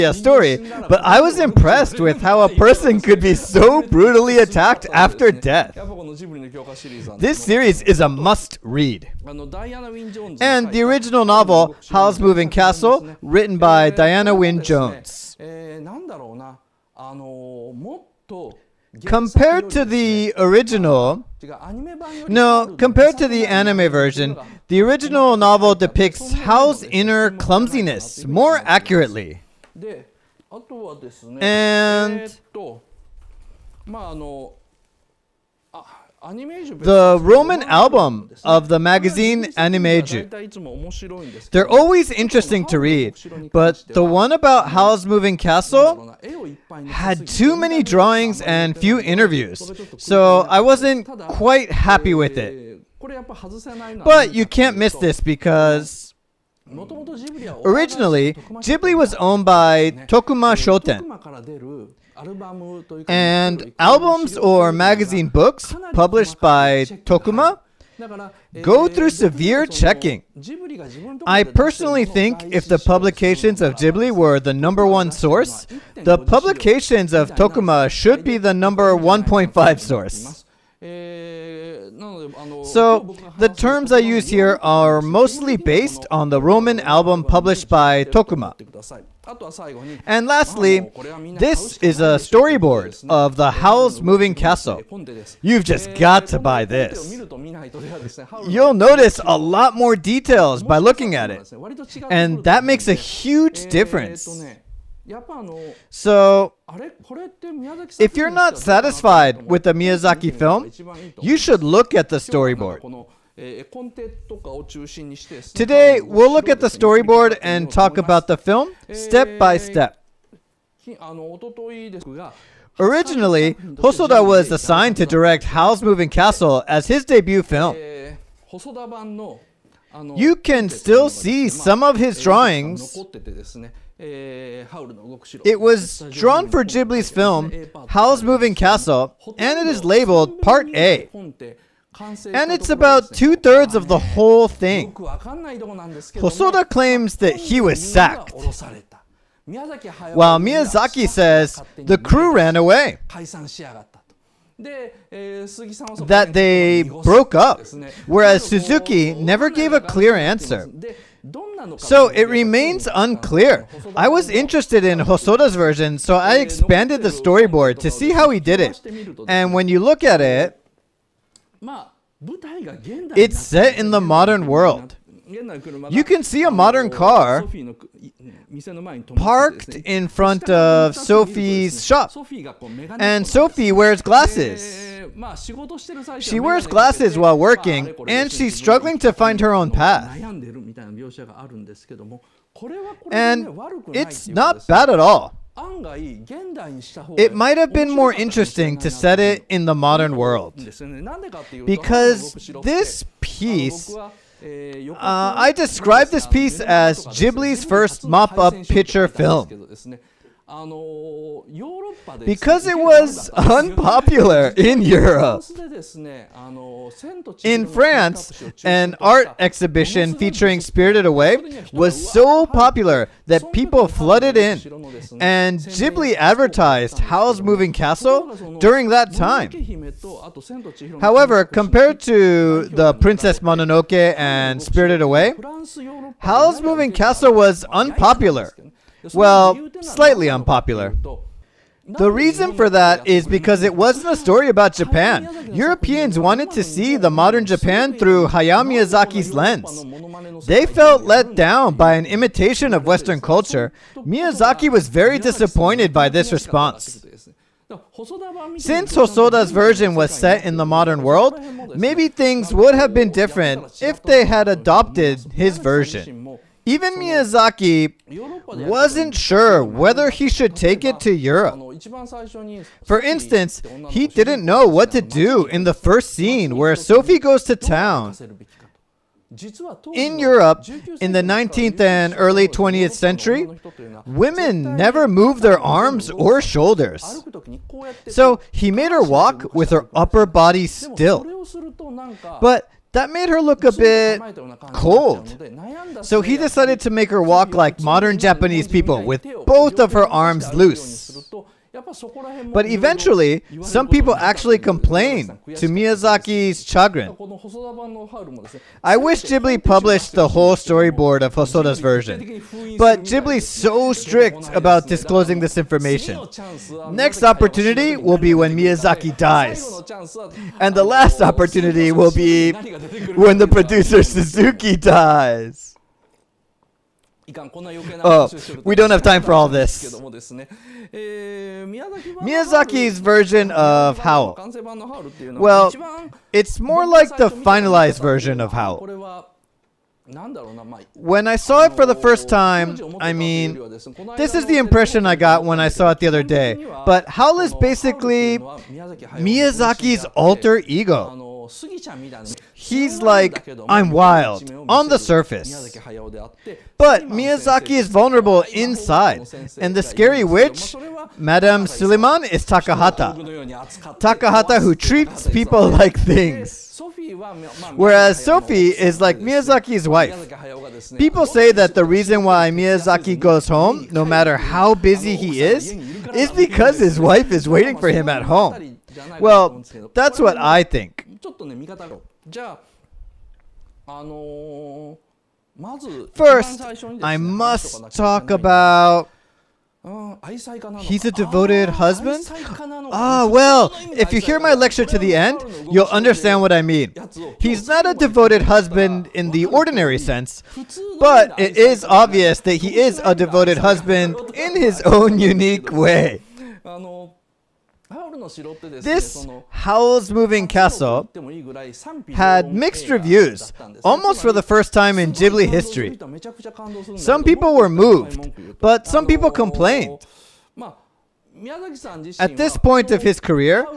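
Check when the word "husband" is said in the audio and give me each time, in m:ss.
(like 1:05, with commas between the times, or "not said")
6:31, 6:38, 6:43.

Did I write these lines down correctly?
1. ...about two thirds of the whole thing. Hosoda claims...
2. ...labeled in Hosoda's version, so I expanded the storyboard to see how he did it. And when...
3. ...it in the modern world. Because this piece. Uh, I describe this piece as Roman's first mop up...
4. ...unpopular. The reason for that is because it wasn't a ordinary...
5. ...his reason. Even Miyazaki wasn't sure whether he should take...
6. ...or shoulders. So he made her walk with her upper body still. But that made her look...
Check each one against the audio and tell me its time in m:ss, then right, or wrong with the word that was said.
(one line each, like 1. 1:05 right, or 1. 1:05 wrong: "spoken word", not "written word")
1. 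2:22 right
2. 2:44 wrong: "interested", not "labeled"
3. 3:19 wrong: "Ghibli", not "Roman"
4. 4:00 wrong: "story", not "ordinary"
5. 4:25 wrong: "version", not "reason"
6. 4:46 right.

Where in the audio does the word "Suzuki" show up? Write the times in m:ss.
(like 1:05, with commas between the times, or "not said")
2:38, 5:24.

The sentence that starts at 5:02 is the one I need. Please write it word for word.
But eventually, some people actually complained to Miyazaki's chagrin.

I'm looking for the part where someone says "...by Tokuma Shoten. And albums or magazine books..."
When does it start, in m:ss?
0:59.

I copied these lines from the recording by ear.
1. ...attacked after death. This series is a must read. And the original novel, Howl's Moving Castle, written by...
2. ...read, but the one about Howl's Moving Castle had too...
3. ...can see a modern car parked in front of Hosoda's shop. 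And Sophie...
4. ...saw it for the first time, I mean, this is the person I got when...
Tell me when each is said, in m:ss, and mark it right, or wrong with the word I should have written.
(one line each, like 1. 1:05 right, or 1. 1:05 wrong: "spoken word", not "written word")
1. 0:04 right
2. 0:42 right
3. 2:56 wrong: "Sophie", not "Hosoda"
4. 5:41 wrong: "impression", not "person".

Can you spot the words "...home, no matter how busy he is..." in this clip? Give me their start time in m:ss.
6:13.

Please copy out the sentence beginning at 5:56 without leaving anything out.
But Miyazaki is vulnerable inside, and the scary witch, Madame Suliman, is Takahata.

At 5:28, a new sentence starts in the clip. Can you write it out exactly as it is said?
Oh, we don't have time for all this.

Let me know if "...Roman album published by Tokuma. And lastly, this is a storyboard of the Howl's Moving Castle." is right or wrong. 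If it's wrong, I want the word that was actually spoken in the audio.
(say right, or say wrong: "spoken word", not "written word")
right.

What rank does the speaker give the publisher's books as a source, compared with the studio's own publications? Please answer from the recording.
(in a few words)
1.5.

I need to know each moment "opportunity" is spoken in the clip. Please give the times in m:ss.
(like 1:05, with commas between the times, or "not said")
5:17, 5:21.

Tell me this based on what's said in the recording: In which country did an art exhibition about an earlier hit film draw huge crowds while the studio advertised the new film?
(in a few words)
France.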